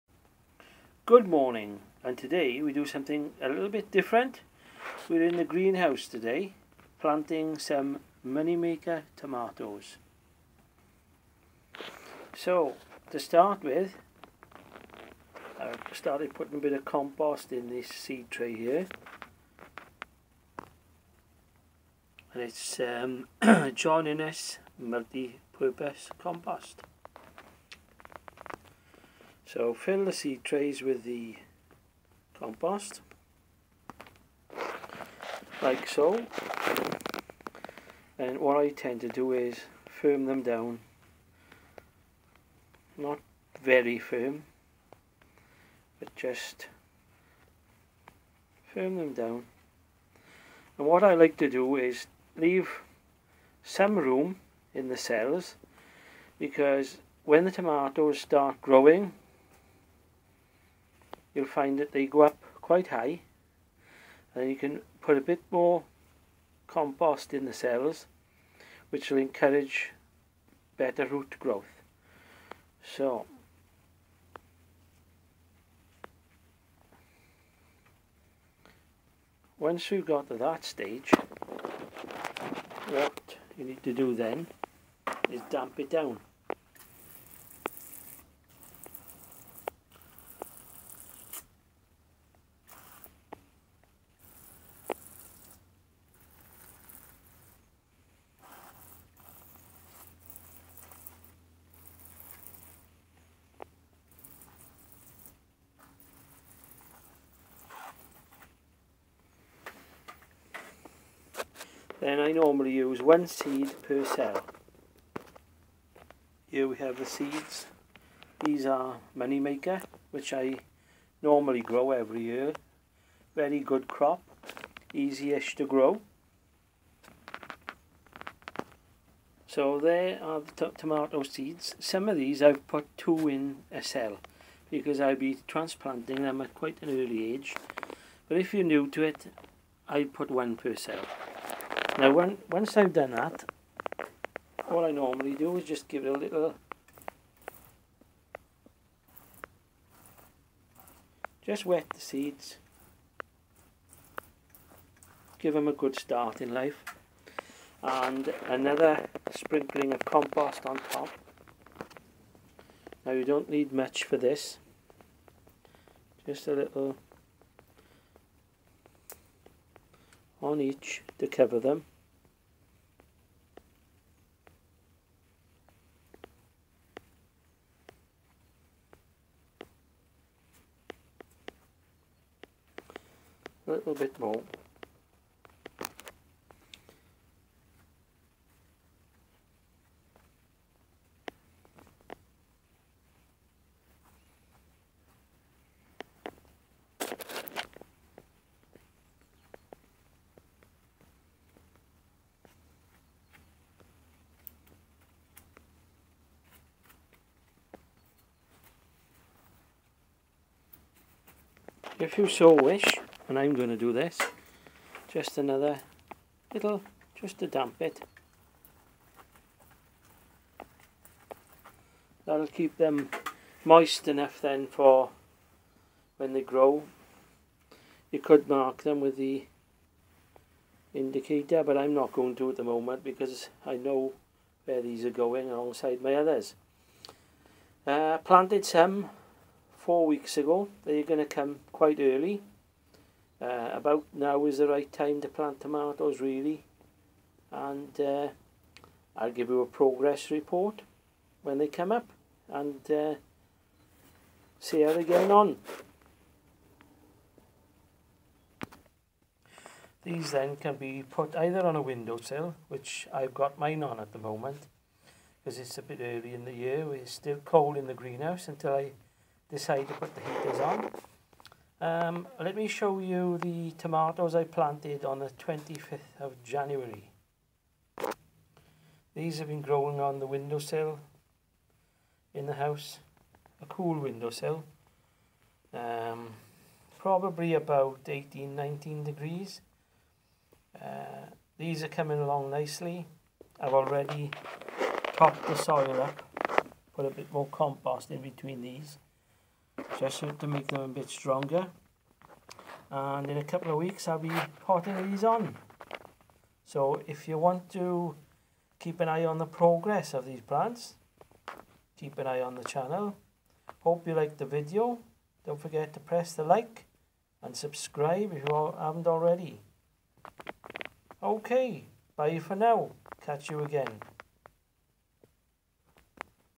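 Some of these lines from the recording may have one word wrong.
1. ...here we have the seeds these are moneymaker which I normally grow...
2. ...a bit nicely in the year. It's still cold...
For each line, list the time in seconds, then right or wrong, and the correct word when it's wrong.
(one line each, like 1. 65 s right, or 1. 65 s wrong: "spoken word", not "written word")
1. 116 s right
2. 265 s wrong: "early", not "nicely".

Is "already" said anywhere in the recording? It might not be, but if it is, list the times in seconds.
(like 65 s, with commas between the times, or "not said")
293 s, 319 s.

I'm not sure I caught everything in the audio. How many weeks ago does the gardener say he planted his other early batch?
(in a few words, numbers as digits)
4 weeks.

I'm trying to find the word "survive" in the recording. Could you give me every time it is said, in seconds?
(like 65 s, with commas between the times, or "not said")
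not said.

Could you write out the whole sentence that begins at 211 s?
If you so wish, and I'm going to do this just another little just to damp it.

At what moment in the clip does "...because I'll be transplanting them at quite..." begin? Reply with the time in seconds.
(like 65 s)
134 s.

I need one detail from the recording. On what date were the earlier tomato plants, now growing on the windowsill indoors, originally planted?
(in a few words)
25th of January.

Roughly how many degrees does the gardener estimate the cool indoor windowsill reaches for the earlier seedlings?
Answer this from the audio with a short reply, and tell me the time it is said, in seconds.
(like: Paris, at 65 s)
18-19 degrees, at 288 s.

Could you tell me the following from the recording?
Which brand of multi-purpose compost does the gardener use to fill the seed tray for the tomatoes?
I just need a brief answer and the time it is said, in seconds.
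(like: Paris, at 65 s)
John Innes, at 23 s.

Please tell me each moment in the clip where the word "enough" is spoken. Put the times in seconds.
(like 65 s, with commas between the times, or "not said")
224 s.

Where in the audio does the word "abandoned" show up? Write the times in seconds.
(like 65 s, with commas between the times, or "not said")
not said.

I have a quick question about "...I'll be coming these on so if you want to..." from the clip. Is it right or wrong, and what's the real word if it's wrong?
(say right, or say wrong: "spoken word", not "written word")
wrong: "potting", not "coming".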